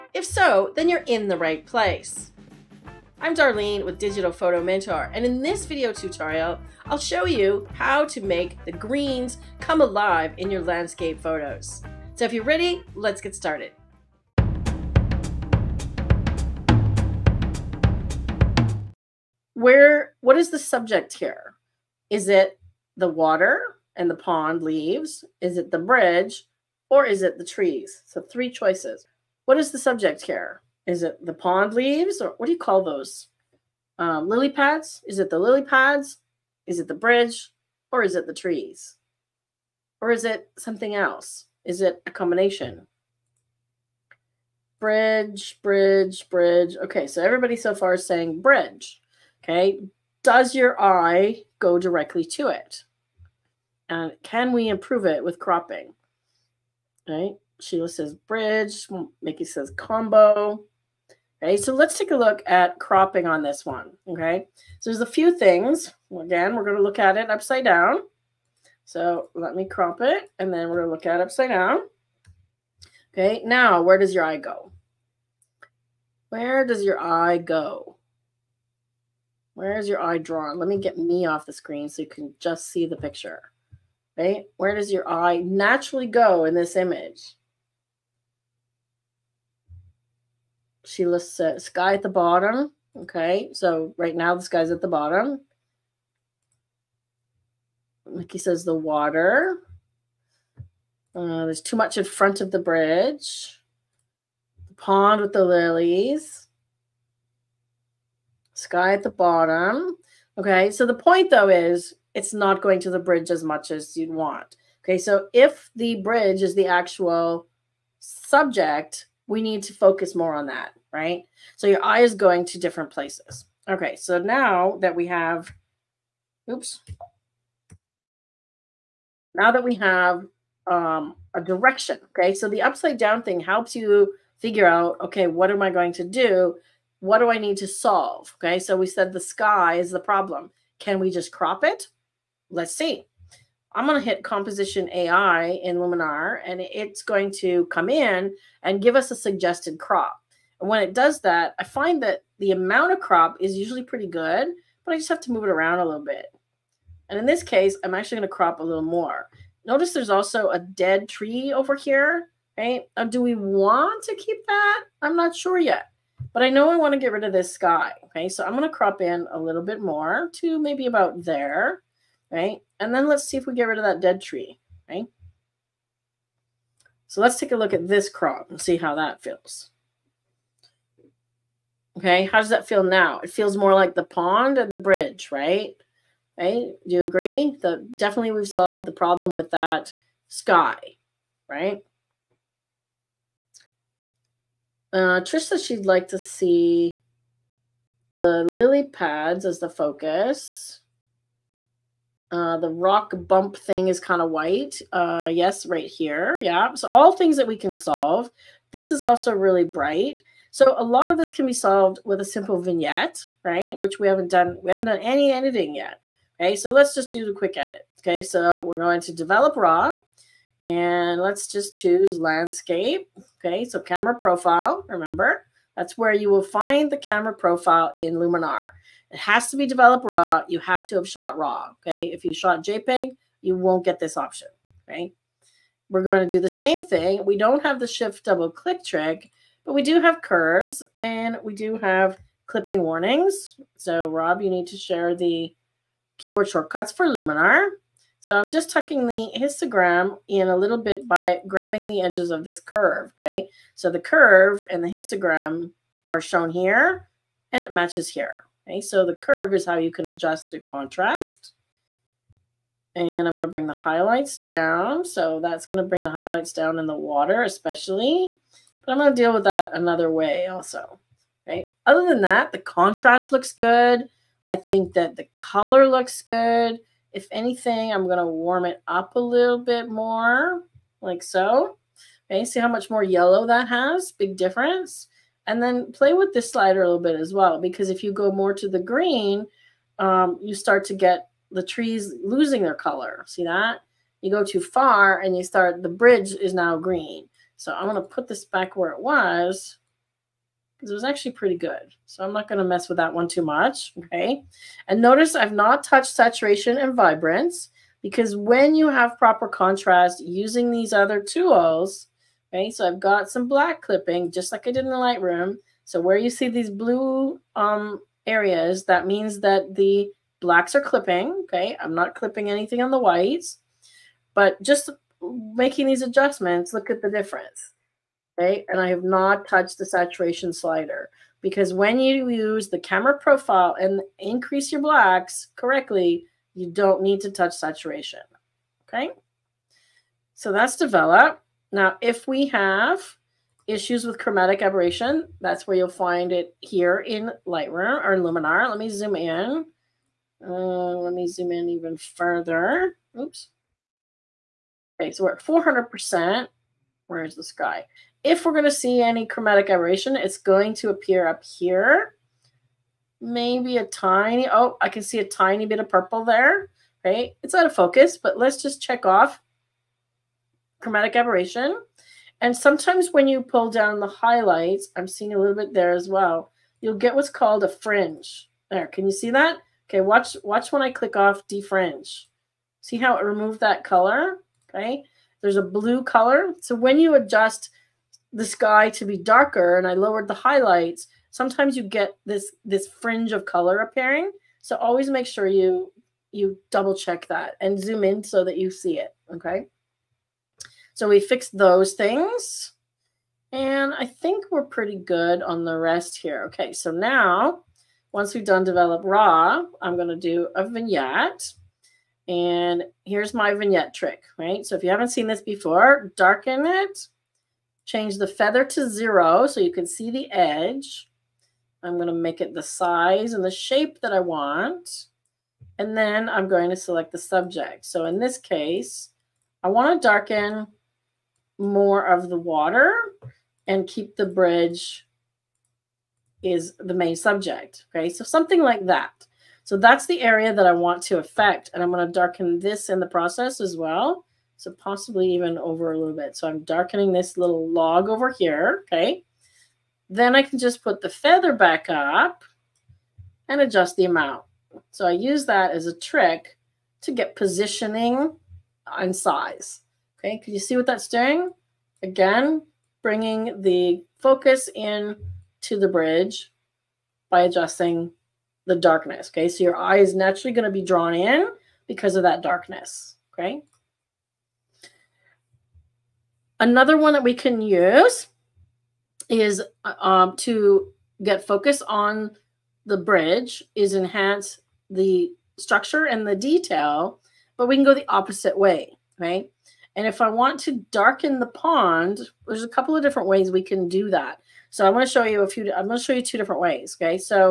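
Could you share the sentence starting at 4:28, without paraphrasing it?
But I'm going to deal with that another way also.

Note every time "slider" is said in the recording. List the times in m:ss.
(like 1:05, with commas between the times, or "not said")
4:46, 5:30.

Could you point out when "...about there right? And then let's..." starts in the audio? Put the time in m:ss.
2:50.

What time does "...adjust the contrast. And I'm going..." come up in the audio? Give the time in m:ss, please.
4:20.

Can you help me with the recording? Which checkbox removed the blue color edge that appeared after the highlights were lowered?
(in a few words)
Defringe.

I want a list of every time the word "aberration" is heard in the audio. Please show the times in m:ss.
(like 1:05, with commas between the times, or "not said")
5:44, 5:59, 6:11.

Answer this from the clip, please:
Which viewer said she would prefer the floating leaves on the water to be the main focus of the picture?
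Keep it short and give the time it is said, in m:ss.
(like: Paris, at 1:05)
Trish, at 3:15.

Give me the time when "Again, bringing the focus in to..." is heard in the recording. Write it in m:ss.
7:42.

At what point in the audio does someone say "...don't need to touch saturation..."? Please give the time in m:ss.
5:36.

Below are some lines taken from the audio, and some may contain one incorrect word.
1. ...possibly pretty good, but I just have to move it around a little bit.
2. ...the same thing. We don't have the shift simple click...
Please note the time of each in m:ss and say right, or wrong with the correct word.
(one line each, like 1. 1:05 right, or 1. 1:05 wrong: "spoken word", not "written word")
1. 2:33 wrong: "usually", not "possibly"
2. 3:56 wrong: "double", not "simple".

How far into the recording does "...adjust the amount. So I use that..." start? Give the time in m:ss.
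7:33.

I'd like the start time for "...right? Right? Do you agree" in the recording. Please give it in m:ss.
3:05.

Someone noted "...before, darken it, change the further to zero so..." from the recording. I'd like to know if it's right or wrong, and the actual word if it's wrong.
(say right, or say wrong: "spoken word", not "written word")
wrong: "feather", not "further".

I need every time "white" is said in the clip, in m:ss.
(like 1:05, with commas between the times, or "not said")
3:24, 5:22.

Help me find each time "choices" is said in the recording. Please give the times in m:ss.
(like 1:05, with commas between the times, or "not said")
0:28.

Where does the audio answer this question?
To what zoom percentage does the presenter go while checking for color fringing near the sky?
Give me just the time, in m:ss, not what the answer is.
5:55.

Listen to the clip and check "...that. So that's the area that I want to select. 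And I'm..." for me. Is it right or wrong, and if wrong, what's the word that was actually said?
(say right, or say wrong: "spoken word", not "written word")
wrong: "affect", not "select".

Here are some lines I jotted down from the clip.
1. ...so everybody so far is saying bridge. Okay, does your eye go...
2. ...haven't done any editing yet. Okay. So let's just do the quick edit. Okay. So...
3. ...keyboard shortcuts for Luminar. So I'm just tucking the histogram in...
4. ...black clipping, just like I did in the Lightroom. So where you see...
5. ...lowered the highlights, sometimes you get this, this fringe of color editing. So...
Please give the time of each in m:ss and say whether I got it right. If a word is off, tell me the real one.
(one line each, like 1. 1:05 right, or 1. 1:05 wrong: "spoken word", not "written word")
1. 0:47 right
2. 3:34 right
3. 4:06 right
4. 5:13 right
5. 6:29 wrong: "appearing", not "editing".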